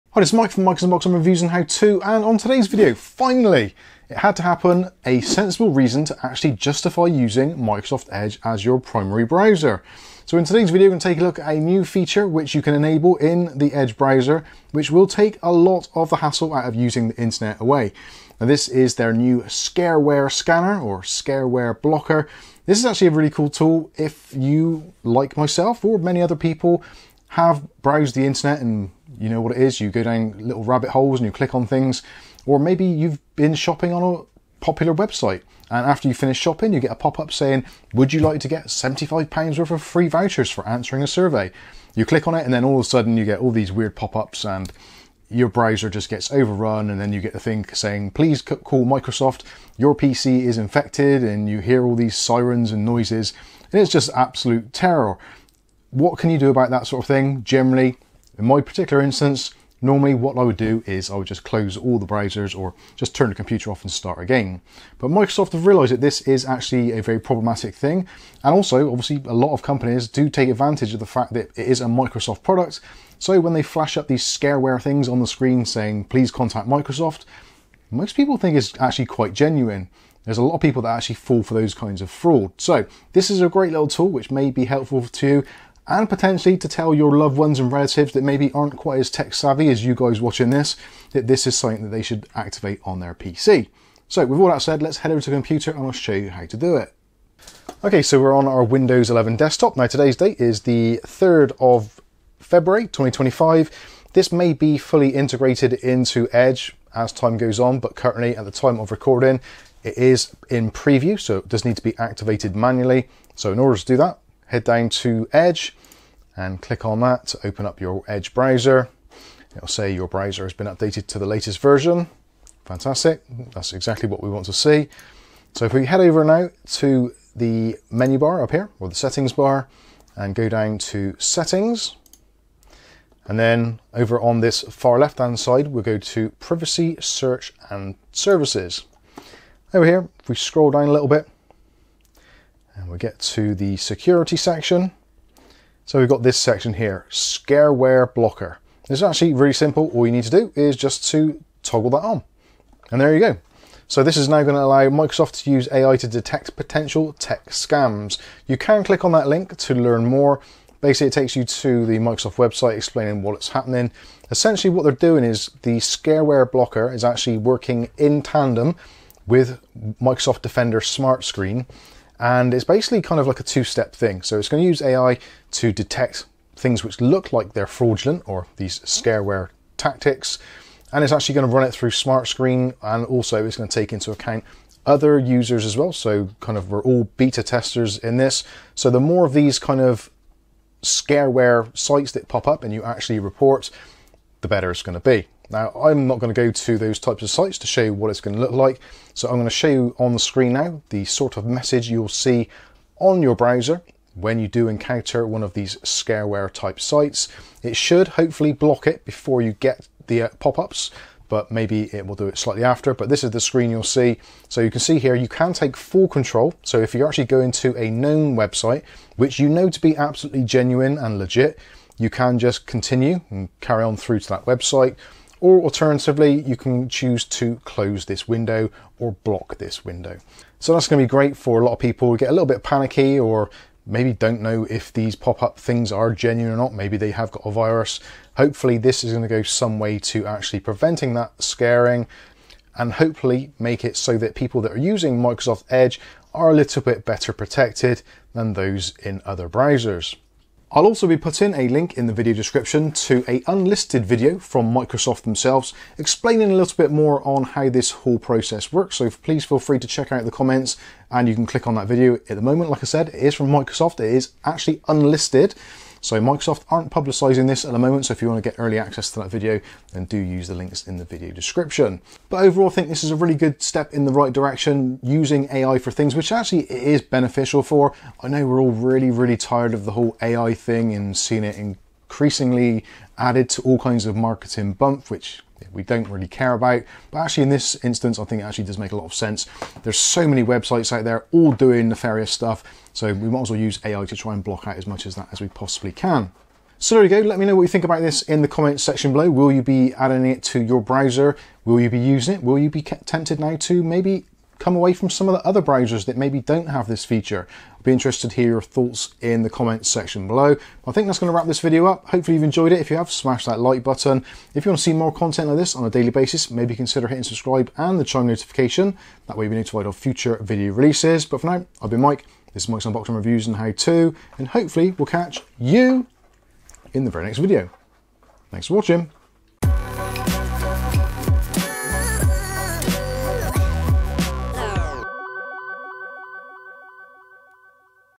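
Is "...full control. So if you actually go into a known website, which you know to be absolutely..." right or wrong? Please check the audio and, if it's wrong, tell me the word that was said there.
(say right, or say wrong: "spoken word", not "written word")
right.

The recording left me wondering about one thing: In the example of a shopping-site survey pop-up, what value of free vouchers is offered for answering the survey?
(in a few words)
£75.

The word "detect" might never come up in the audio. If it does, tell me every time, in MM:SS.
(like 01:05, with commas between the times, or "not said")
02:36, 02:55.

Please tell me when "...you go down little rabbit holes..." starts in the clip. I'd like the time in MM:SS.
00:29.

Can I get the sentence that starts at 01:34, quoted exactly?
So with all that said, let's head over to the computer and I'll show you how to do it.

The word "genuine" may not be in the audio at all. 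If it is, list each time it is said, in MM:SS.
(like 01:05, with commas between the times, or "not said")
01:19, 03:40, 03:56.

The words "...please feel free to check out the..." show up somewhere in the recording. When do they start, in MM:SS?
04:19.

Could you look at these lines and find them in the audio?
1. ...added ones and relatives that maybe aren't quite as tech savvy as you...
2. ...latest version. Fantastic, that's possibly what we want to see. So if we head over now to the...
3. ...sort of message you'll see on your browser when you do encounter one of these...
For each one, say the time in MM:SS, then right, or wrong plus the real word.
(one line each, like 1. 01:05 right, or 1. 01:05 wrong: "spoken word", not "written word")
1. 01:27 wrong: "loved", not "added"
2. 02:01 wrong: "exactly", not "possibly"
3. 03:21 right.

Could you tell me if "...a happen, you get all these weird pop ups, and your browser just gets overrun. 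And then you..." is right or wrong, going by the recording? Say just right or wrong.
wrong.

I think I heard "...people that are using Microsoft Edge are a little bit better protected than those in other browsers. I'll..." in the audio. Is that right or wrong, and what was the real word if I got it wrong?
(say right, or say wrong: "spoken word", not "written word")
right.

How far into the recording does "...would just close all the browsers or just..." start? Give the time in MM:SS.
01:01.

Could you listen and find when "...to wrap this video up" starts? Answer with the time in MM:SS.
05:11.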